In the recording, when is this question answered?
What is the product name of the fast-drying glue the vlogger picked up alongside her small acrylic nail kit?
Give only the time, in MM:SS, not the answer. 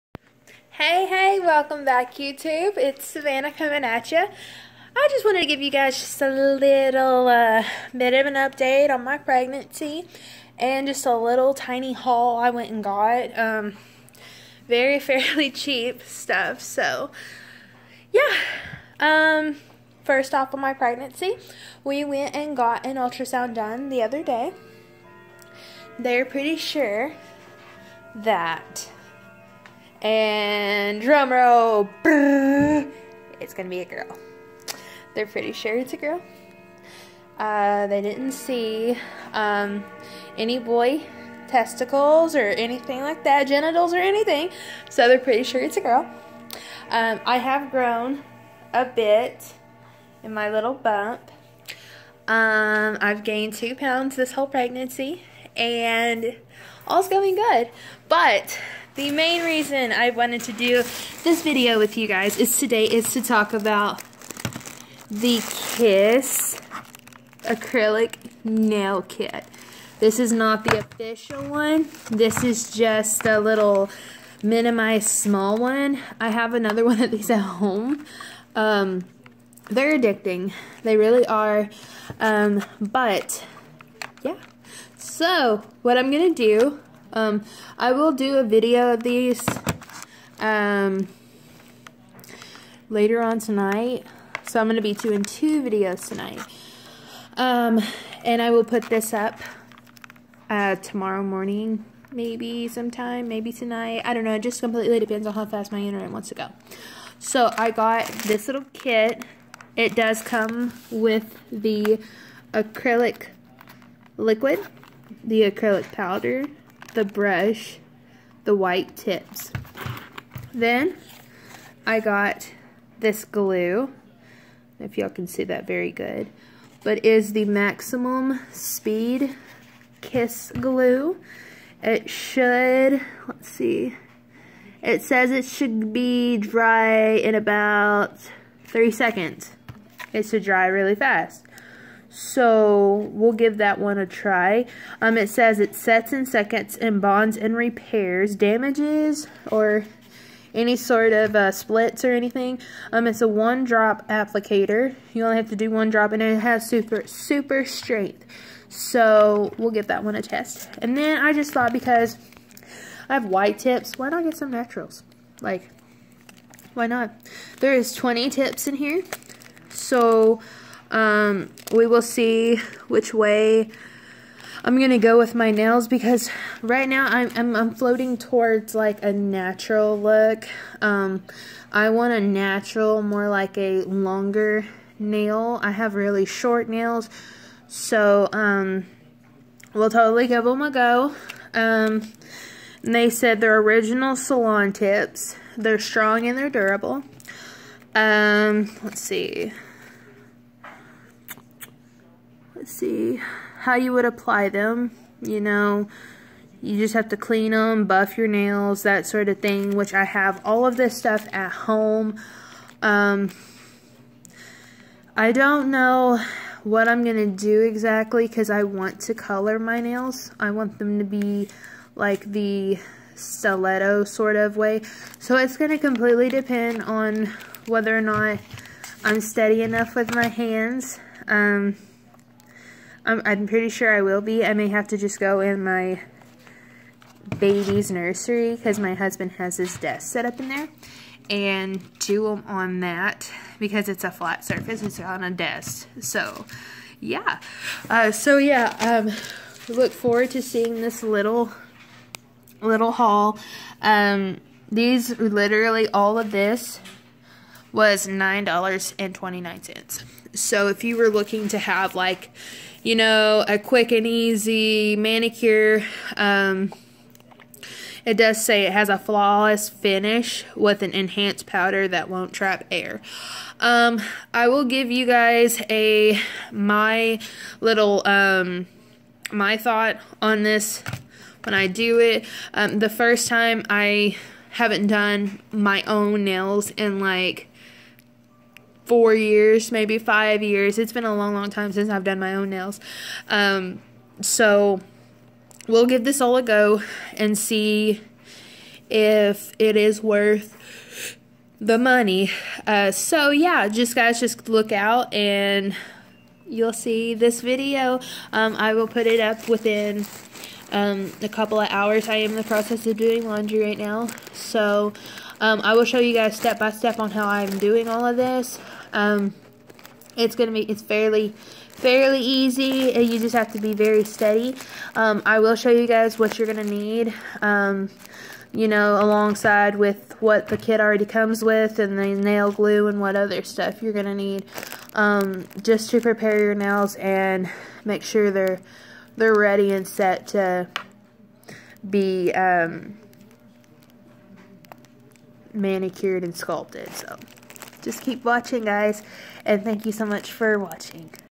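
02:07.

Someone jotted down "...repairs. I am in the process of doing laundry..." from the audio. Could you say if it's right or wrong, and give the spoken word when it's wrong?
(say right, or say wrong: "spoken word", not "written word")
wrong: "hours", not "repairs".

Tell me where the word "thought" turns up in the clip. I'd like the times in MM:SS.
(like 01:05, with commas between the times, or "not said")
02:41, 04:39.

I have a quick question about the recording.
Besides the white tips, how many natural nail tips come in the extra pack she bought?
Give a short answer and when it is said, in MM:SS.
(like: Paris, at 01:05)
20, at 02:47.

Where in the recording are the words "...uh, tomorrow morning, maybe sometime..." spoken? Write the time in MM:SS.
01:40.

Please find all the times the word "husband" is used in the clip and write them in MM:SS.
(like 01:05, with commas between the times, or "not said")
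03:58.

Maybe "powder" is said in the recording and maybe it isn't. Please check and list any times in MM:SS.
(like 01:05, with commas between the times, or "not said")
01:55, 04:31.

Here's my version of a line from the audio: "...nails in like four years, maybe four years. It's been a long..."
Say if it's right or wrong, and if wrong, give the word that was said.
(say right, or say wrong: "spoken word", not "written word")
wrong: "five", not "four".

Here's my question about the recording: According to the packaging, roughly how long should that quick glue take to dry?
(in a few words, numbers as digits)
3 seconds.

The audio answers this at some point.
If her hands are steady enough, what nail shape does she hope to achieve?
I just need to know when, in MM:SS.
03:43.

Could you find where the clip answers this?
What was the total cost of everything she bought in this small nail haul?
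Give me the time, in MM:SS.
04:18.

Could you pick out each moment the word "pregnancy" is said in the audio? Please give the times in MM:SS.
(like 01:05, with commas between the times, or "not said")
00:09, 00:20, 00:54.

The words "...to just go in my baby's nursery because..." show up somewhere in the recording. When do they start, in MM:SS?
03:54.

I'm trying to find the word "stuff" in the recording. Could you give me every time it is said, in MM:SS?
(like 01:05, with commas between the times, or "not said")
00:16, 03:30, 05:33.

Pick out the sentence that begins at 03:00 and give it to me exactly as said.
Um, I want a natural, more like a longer nail.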